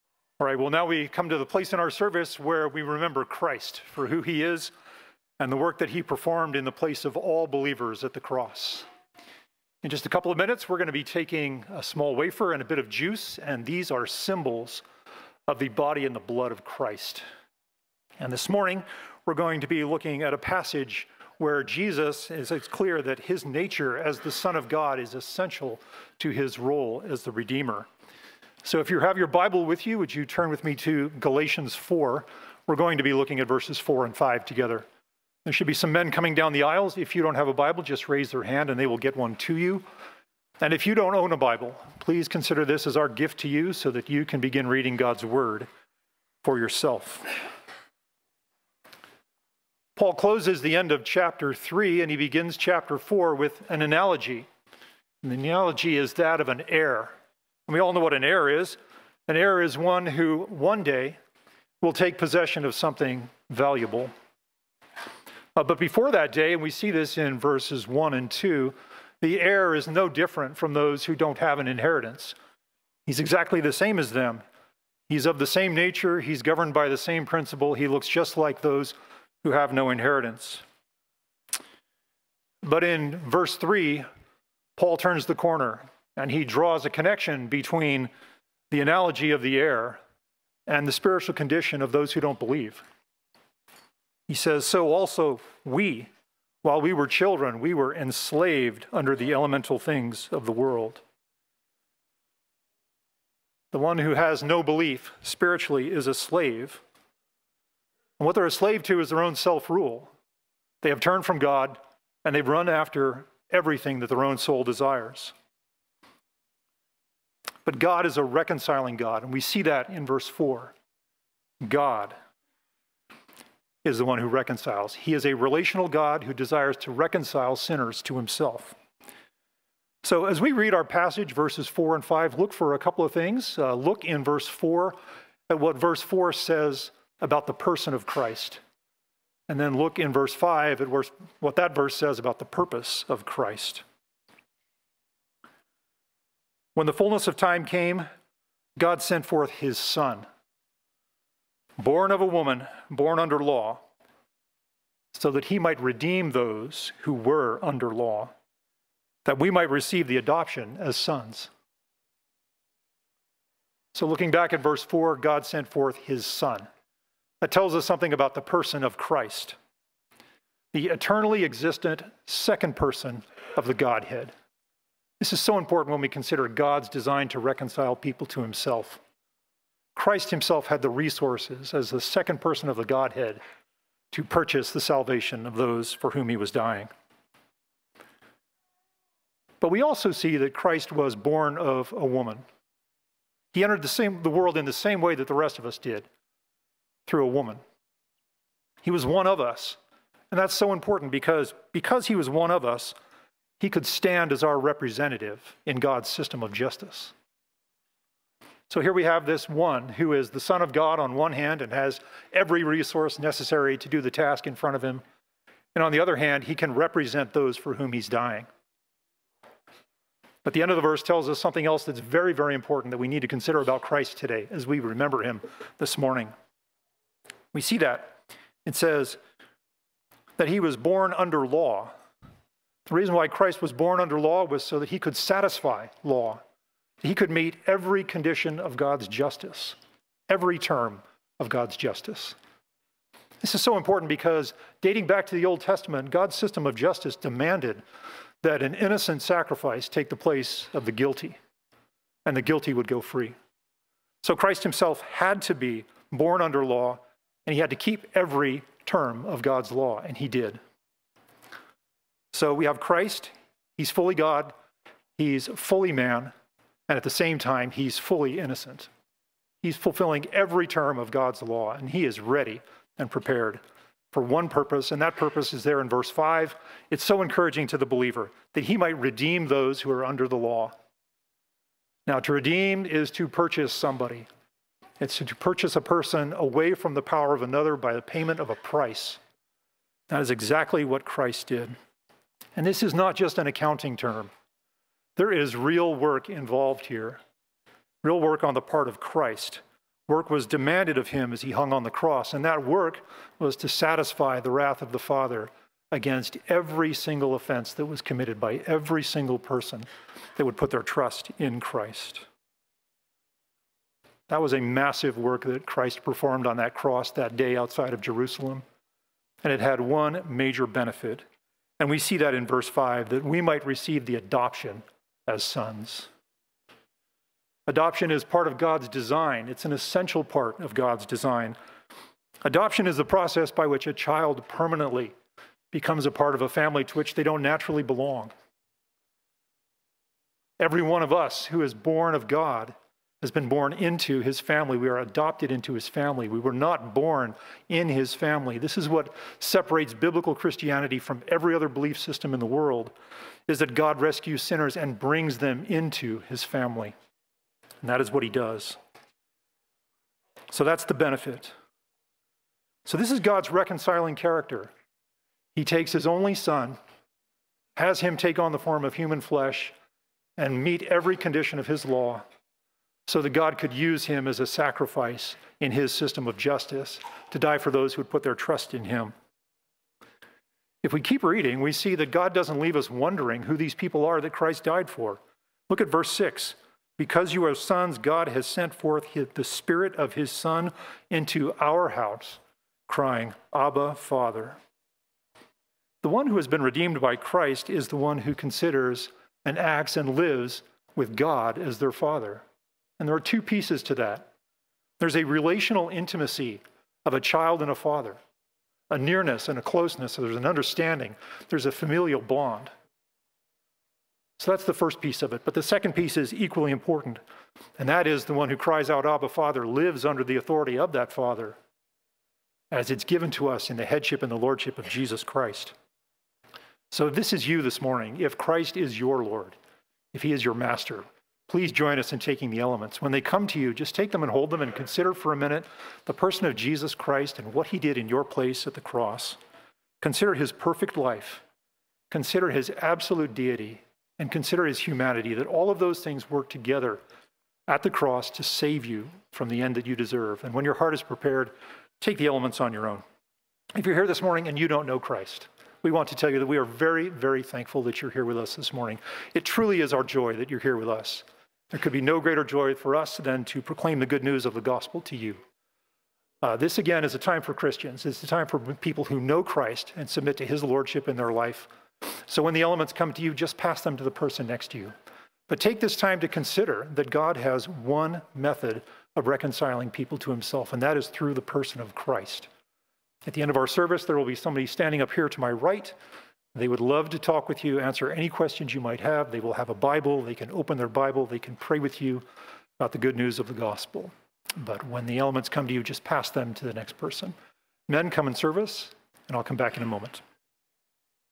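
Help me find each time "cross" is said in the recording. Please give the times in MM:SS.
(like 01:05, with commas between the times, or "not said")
00:08, 05:01, 05:16, 07:18, 07:27.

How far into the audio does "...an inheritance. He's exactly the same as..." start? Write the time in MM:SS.
01:11.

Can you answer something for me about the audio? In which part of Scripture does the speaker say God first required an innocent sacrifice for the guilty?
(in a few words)
The Old Testament.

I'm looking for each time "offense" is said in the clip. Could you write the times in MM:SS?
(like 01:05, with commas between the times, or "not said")
05:07.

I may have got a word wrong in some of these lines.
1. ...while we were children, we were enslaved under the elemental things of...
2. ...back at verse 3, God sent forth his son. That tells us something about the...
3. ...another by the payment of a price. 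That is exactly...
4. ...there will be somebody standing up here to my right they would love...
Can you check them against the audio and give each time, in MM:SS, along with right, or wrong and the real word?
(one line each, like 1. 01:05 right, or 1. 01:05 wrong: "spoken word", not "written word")
1. 01:36 right
2. 02:44 wrong: "4", not "3"
3. 04:47 right
4. 08:04 right.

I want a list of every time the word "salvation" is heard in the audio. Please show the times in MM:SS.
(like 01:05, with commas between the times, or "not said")
03:04.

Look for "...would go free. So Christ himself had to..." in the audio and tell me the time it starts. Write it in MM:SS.
04:12.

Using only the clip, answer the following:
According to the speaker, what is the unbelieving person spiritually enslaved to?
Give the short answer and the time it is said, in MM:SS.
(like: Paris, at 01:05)
Their own self rule, at 01:49.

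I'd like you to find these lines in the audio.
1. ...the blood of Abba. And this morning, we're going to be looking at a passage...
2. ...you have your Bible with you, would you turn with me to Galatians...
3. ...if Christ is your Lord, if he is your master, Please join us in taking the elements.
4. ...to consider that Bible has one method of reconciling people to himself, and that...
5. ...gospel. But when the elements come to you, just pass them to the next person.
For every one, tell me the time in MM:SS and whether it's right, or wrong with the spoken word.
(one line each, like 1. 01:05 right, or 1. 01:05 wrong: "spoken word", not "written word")
1. 00:16 wrong: "Christ", not "Abba"
2. 00:28 right
3. 07:08 right
4. 07:56 wrong: "God", not "Bible"
5. 08:13 right.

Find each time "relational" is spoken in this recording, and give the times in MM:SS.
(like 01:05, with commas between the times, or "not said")
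02:05, 06:45.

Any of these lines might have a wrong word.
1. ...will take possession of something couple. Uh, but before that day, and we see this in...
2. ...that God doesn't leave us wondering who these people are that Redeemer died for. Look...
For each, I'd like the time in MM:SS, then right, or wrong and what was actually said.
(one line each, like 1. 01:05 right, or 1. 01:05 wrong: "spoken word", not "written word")
1. 01:01 wrong: "valuable", not "couple"
2. 06:21 wrong: "Christ", not "Redeemer".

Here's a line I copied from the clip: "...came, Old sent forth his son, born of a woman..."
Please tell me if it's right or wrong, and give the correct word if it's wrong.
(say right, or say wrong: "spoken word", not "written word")
wrong: "God", not "Old".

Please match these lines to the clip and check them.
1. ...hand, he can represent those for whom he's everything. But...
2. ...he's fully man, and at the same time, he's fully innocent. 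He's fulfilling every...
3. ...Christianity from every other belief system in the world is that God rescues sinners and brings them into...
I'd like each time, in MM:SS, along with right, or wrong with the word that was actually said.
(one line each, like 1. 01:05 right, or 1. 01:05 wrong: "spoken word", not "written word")
1. 03:36 wrong: "dying", not "everything"
2. 04:25 right
3. 05:50 right.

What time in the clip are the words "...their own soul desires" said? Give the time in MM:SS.
01:54.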